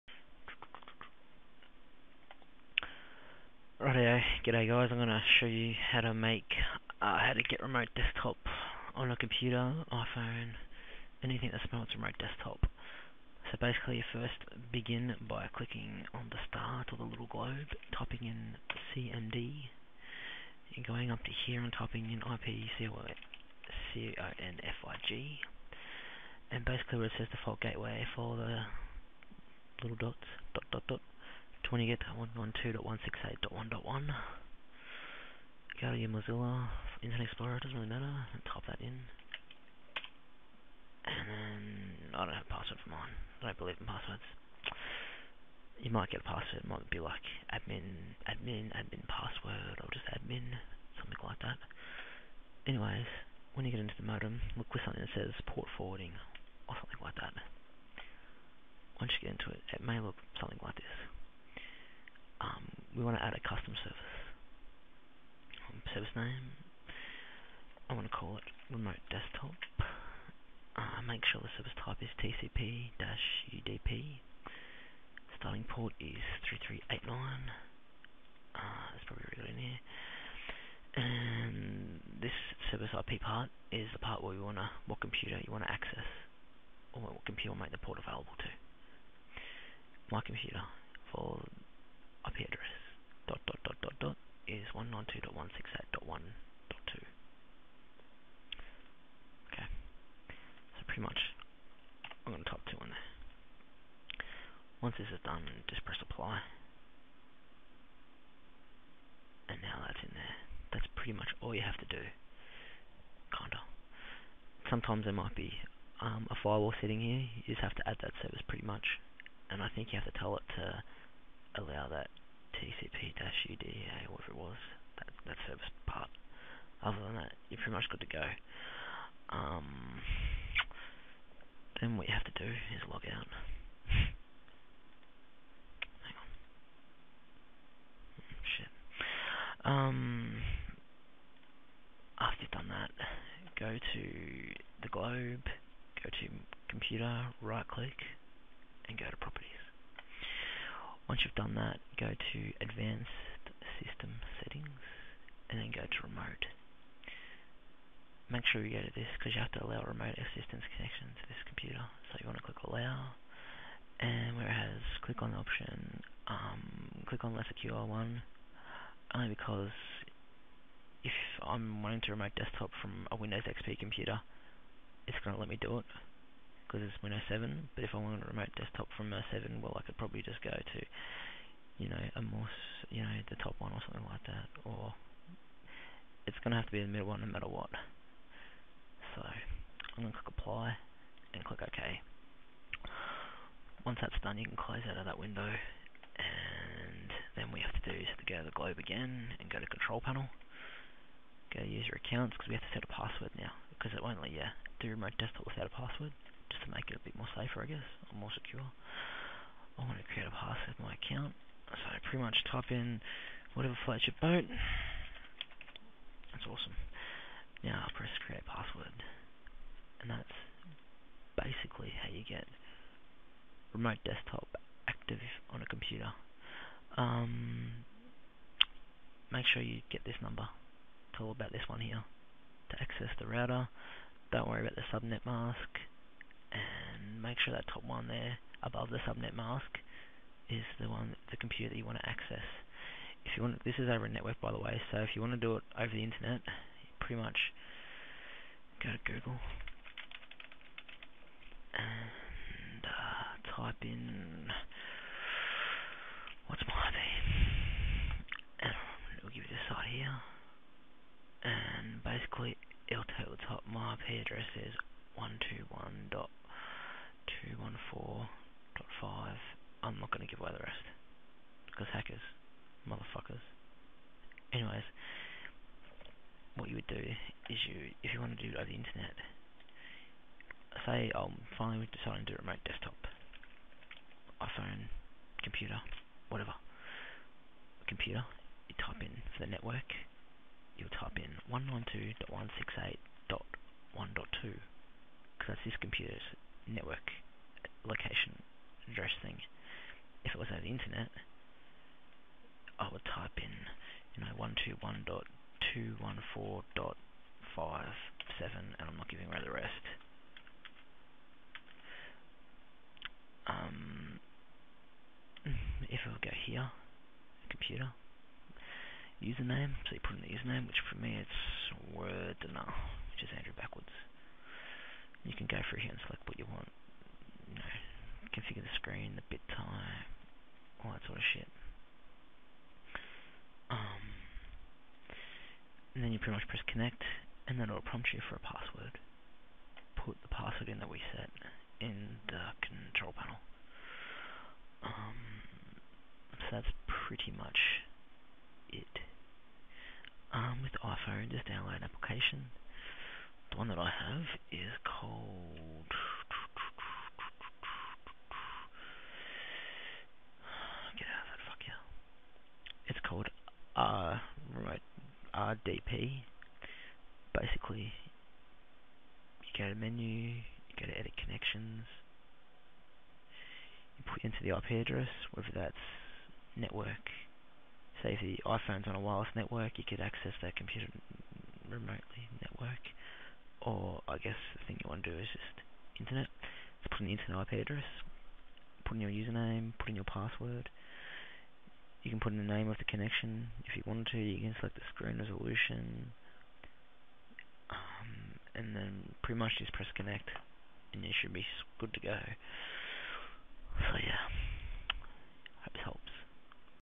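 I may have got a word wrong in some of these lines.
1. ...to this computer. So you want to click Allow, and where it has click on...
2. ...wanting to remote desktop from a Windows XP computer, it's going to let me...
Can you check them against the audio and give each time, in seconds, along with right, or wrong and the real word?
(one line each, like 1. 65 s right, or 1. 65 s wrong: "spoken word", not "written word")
1. 161 s right
2. 171 s right.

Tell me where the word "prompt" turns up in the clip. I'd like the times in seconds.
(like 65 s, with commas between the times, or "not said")
337 s.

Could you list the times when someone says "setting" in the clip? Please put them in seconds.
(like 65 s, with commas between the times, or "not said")
116 s, 154 s.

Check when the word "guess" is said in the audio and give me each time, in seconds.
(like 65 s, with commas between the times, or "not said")
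207 s, 384 s.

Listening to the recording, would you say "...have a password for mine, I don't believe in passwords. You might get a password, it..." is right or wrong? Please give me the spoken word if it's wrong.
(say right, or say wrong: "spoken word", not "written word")
right.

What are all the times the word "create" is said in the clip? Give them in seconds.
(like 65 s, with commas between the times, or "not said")
210 s, 218 s.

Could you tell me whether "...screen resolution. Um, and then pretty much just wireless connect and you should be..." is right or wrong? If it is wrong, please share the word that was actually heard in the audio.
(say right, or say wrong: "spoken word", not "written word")
wrong: "press", not "wireless".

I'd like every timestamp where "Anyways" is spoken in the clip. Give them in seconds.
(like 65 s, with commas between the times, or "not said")
52 s, 274 s.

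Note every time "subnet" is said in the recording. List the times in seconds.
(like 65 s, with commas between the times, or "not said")
234 s, 239 s.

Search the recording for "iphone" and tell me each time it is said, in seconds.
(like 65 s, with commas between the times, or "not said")
9 s, 284 s, 350 s, 378 s.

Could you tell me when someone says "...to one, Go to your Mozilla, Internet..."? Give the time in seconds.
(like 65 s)
32 s.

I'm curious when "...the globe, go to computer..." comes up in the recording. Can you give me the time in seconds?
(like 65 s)
144 s.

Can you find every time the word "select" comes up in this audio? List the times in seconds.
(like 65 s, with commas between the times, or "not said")
326 s, 394 s.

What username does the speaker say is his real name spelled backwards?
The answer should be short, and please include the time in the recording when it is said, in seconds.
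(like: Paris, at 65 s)
Andrew, at 323 s.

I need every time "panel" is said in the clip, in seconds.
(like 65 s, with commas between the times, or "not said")
199 s, 343 s.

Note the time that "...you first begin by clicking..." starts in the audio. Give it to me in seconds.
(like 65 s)
13 s.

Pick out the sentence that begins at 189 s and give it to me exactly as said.
So, I'm going to click apply, and click OK.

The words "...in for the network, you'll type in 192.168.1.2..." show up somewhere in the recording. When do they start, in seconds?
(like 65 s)
288 s.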